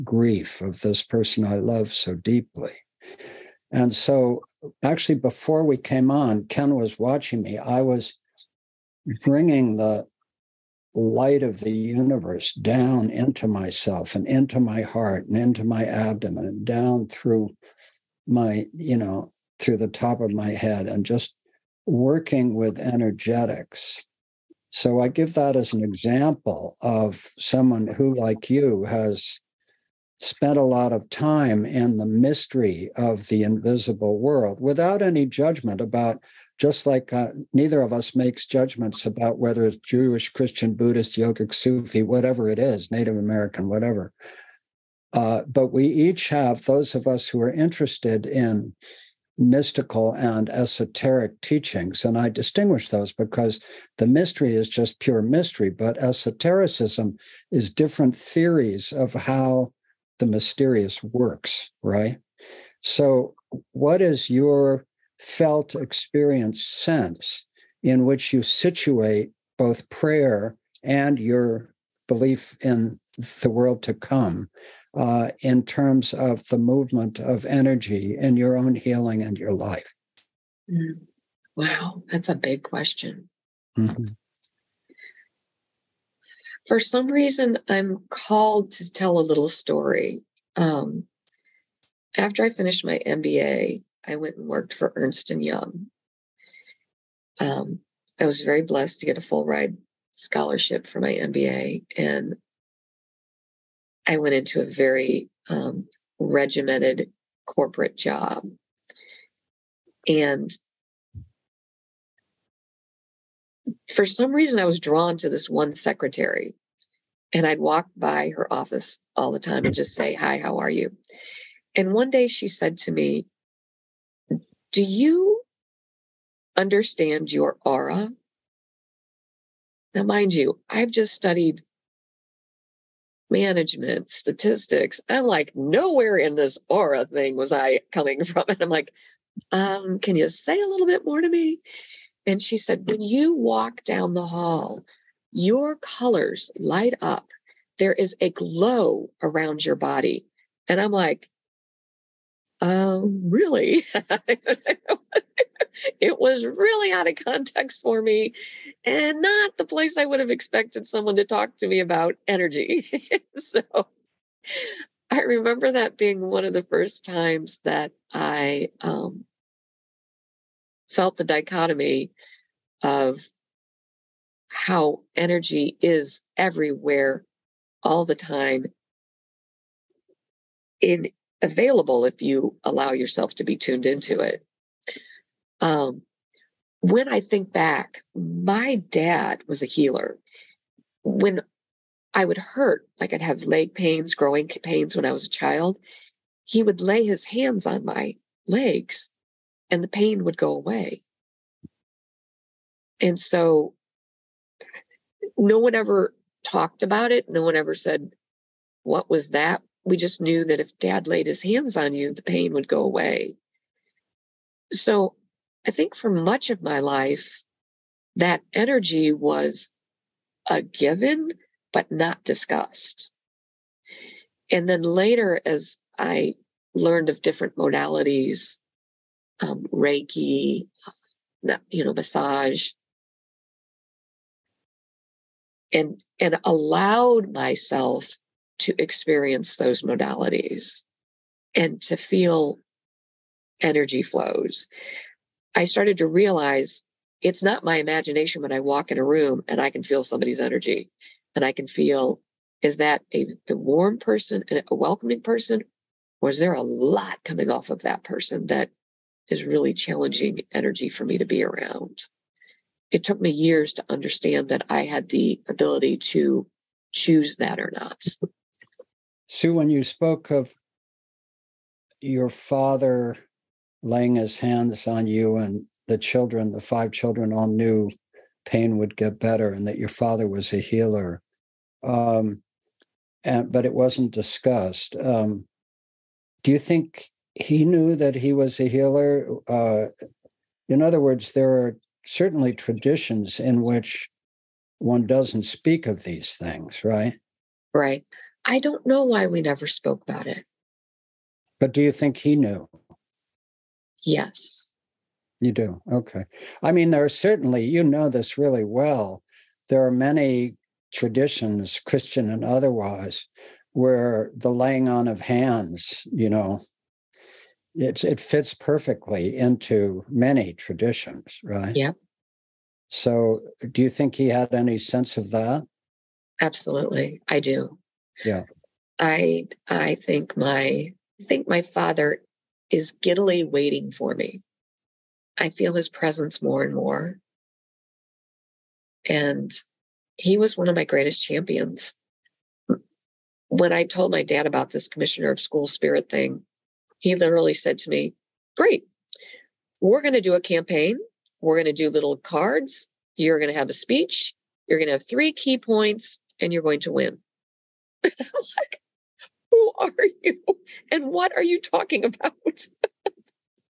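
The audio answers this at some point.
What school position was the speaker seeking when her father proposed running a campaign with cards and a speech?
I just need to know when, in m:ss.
5:44.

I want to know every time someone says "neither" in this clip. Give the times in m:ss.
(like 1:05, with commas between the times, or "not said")
0:37.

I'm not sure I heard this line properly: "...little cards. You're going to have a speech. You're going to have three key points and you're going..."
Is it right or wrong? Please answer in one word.
right.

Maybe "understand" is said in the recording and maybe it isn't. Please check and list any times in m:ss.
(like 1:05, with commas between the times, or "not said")
2:06, 4:23.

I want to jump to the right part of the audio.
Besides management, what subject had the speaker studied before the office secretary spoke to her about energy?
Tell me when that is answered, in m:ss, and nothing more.
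2:14.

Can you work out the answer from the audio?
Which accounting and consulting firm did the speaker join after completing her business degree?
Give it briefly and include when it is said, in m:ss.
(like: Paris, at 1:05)
Ernst and Young, at 1:34.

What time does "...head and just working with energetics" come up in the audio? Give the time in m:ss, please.
0:20.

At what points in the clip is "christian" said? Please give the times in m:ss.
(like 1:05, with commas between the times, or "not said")
0:40, 5:11.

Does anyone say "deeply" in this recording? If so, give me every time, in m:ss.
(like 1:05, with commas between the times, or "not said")
0:02.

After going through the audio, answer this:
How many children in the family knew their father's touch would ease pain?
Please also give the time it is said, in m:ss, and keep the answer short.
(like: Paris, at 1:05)
5, at 4:36.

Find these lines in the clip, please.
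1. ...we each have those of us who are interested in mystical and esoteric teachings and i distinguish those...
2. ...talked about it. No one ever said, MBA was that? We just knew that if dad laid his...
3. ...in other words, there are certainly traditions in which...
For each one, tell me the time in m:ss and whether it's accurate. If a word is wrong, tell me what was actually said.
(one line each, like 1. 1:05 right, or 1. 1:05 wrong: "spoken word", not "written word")
1. 0:45 right
2. 3:26 wrong: "What", not "MBA"
3. 4:50 right.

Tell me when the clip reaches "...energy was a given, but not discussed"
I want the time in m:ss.
3:38.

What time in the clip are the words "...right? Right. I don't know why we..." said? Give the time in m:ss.
4:56.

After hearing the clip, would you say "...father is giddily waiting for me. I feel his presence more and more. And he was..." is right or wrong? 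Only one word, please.
right.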